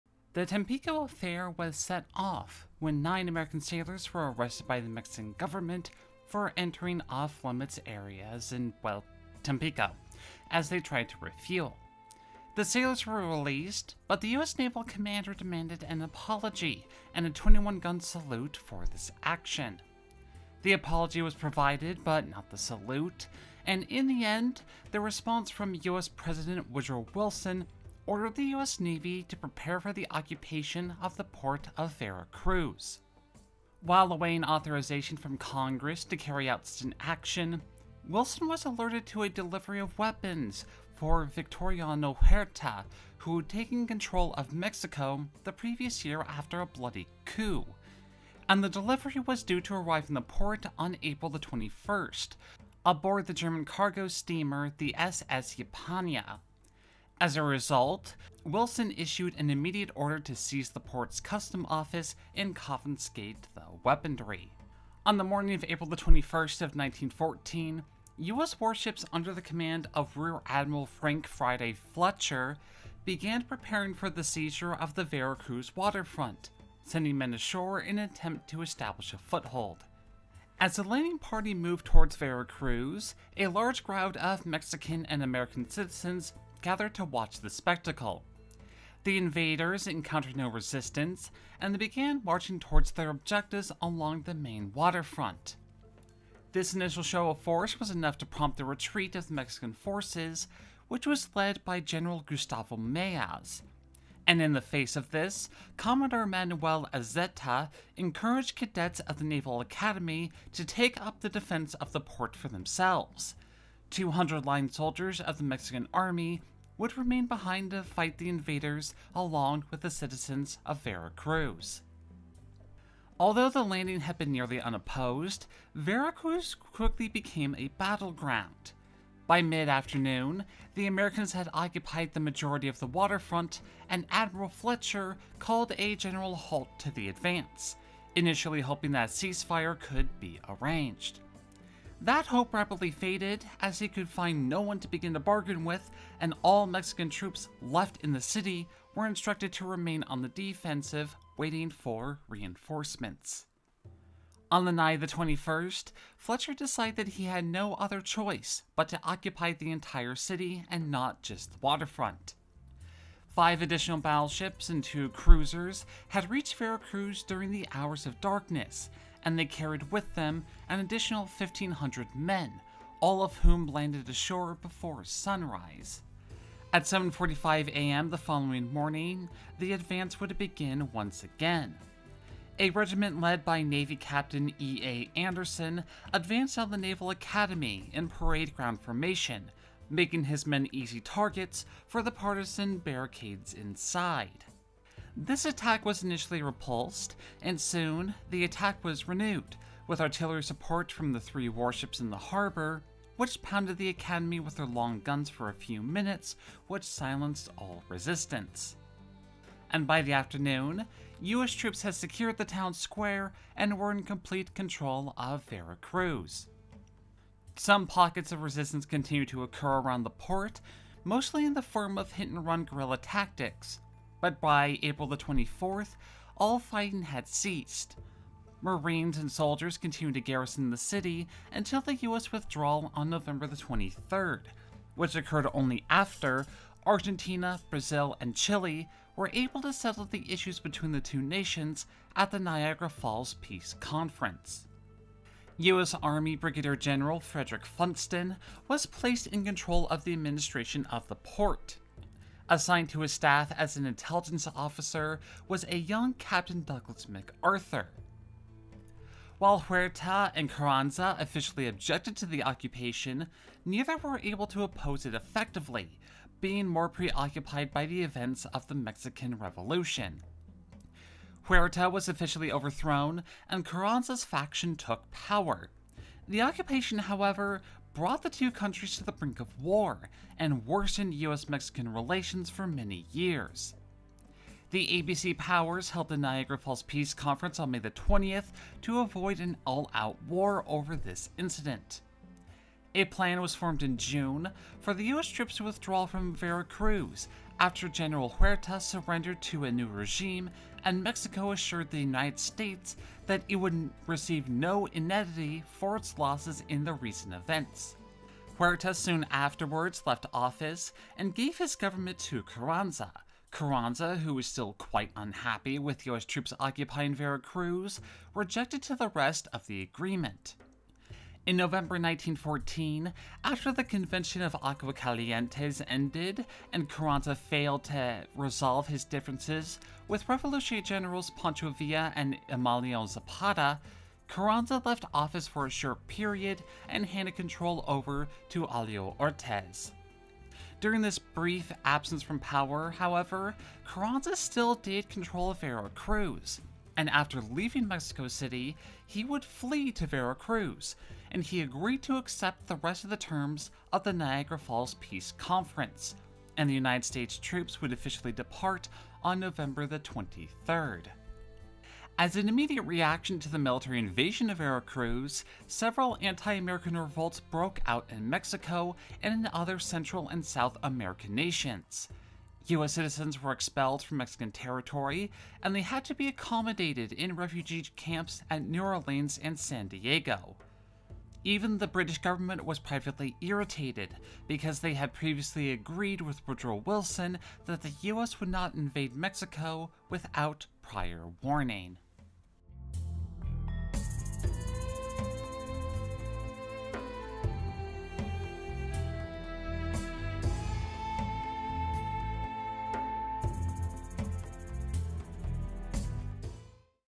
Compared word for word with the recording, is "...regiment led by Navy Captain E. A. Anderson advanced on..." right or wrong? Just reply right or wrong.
right.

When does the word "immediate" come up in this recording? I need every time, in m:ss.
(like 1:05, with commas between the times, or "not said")
0:59, 6:02.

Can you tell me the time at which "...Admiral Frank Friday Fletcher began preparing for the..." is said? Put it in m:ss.
1:10.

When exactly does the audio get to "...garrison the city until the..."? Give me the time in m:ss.
3:50.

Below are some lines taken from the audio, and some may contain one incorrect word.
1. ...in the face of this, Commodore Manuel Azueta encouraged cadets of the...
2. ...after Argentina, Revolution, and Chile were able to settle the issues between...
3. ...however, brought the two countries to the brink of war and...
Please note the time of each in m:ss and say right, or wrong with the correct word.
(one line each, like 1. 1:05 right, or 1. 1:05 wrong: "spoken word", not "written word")
1. 1:44 right
2. 3:55 wrong: "Brazil", not "Revolution"
3. 4:36 right.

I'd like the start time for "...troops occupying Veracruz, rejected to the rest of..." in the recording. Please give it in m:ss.
5:16.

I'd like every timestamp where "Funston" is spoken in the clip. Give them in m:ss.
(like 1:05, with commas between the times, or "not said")
4:07.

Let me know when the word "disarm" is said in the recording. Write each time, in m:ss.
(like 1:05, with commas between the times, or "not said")
not said.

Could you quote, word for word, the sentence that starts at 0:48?
And the delivery was due to arrive in the port on April the 21st, aboard the German cargo steamer the SS Ypiranga.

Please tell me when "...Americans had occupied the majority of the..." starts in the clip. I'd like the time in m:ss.
2:10.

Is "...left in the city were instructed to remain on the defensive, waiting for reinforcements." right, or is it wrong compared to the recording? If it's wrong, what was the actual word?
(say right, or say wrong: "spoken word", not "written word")
right.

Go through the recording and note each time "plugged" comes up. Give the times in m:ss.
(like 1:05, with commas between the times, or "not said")
not said.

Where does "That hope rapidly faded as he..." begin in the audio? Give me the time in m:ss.
2:22.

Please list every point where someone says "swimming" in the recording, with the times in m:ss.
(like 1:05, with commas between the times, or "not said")
not said.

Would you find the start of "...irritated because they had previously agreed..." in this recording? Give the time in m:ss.
6:23.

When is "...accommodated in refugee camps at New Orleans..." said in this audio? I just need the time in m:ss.
6:16.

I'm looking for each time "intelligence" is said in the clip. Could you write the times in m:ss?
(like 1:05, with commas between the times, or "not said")
4:13.